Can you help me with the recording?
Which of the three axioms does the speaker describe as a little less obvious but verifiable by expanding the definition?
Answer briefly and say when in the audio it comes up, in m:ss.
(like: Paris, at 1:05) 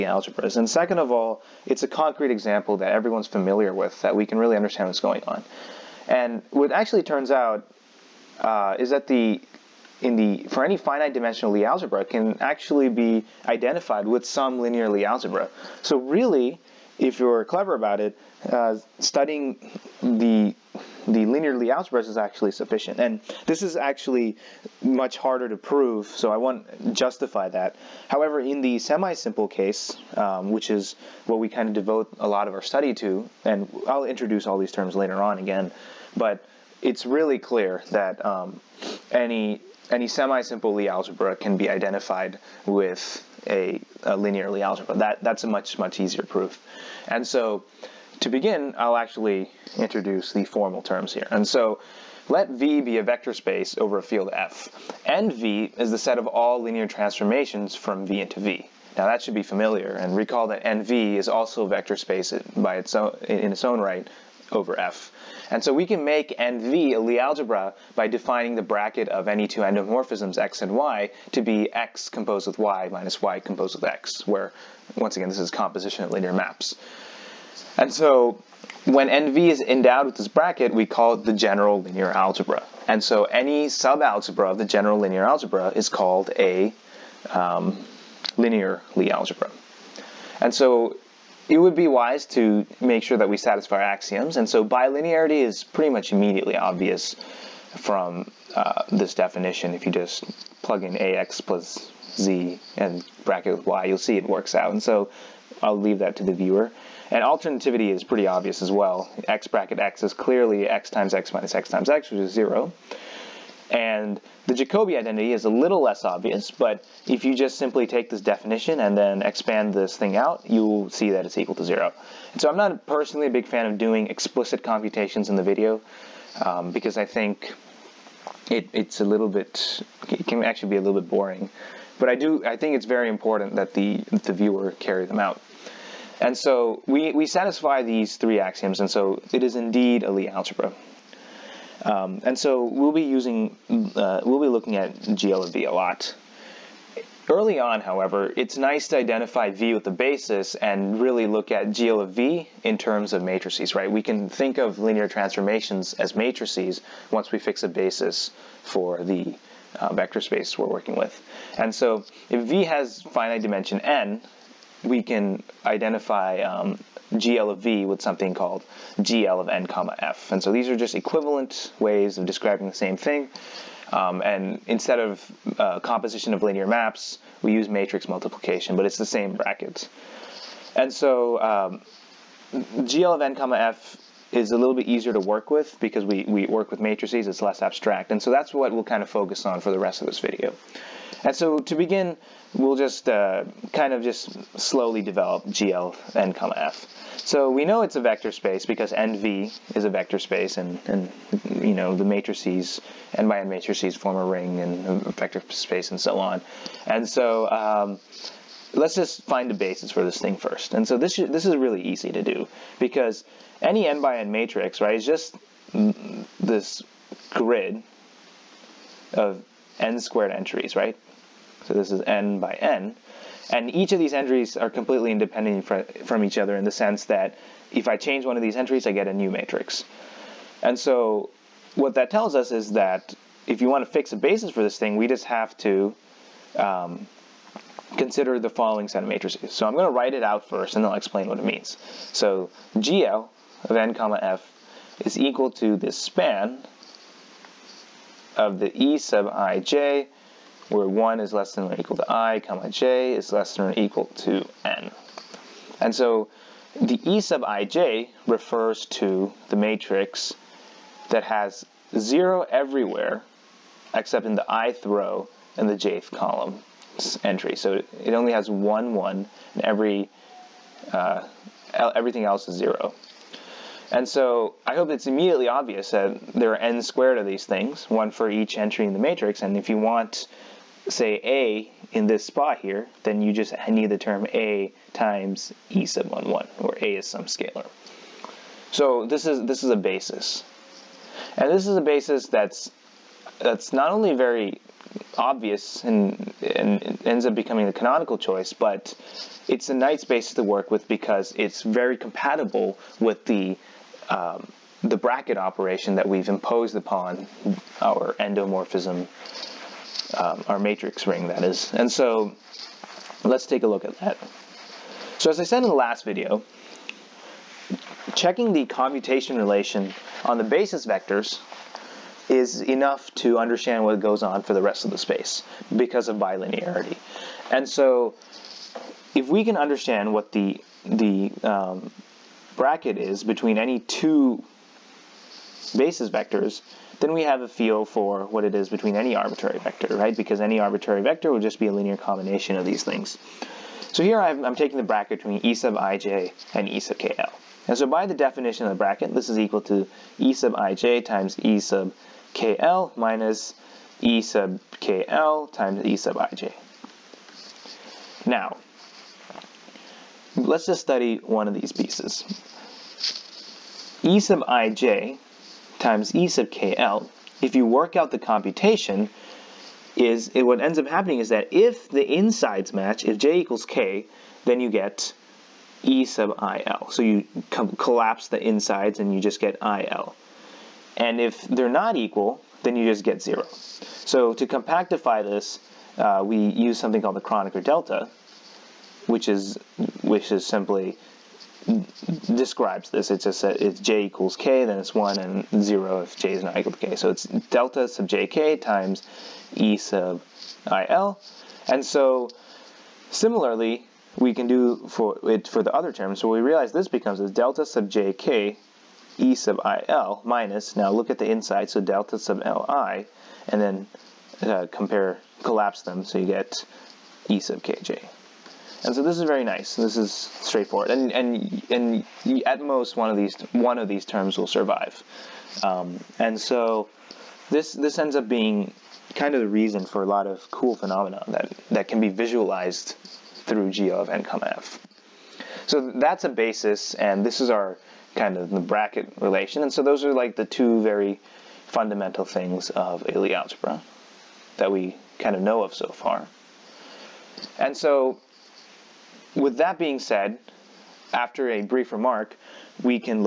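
Jacobi identity, at 1:54.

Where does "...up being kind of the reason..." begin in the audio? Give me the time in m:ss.
7:08.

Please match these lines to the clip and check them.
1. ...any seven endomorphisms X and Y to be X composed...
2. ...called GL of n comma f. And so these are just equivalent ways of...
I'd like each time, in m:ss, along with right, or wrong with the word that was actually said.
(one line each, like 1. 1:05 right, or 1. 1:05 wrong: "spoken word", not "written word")
1. 1:09 wrong: "two", not "seven"
2. 2:48 right.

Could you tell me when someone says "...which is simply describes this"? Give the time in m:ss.
6:30.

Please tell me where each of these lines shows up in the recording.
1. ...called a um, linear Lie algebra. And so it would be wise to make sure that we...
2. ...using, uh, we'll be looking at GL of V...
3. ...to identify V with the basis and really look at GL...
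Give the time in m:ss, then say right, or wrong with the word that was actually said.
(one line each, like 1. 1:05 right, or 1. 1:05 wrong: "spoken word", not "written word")
1. 1:25 right
2. 2:23 right
3. 2:28 right.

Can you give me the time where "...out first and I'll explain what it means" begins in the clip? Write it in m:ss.
4:00.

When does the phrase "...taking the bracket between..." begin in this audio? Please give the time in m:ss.
5:44.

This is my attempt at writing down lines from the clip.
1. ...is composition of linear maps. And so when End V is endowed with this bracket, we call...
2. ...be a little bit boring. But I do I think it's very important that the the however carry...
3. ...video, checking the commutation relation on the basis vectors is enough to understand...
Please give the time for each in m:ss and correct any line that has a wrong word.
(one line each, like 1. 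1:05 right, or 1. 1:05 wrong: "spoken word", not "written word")
1. 1:15 right
2. 2:10 wrong: "viewer", not "however"
3. 5:16 right.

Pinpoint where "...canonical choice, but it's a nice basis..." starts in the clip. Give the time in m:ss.
4:57.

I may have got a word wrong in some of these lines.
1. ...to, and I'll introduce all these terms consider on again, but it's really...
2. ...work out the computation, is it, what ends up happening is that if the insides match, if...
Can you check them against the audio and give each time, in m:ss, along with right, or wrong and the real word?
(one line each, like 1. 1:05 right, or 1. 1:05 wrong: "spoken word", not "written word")
1. 0:32 wrong: "later", not "consider"
2. 6:07 right.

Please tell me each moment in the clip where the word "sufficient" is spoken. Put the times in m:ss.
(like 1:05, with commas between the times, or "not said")
0:22.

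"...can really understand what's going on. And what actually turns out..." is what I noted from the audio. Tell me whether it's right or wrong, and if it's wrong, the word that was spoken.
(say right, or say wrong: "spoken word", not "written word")
right.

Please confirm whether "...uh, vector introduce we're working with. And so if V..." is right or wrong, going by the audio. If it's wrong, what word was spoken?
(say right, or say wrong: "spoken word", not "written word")
wrong: "space", not "introduce".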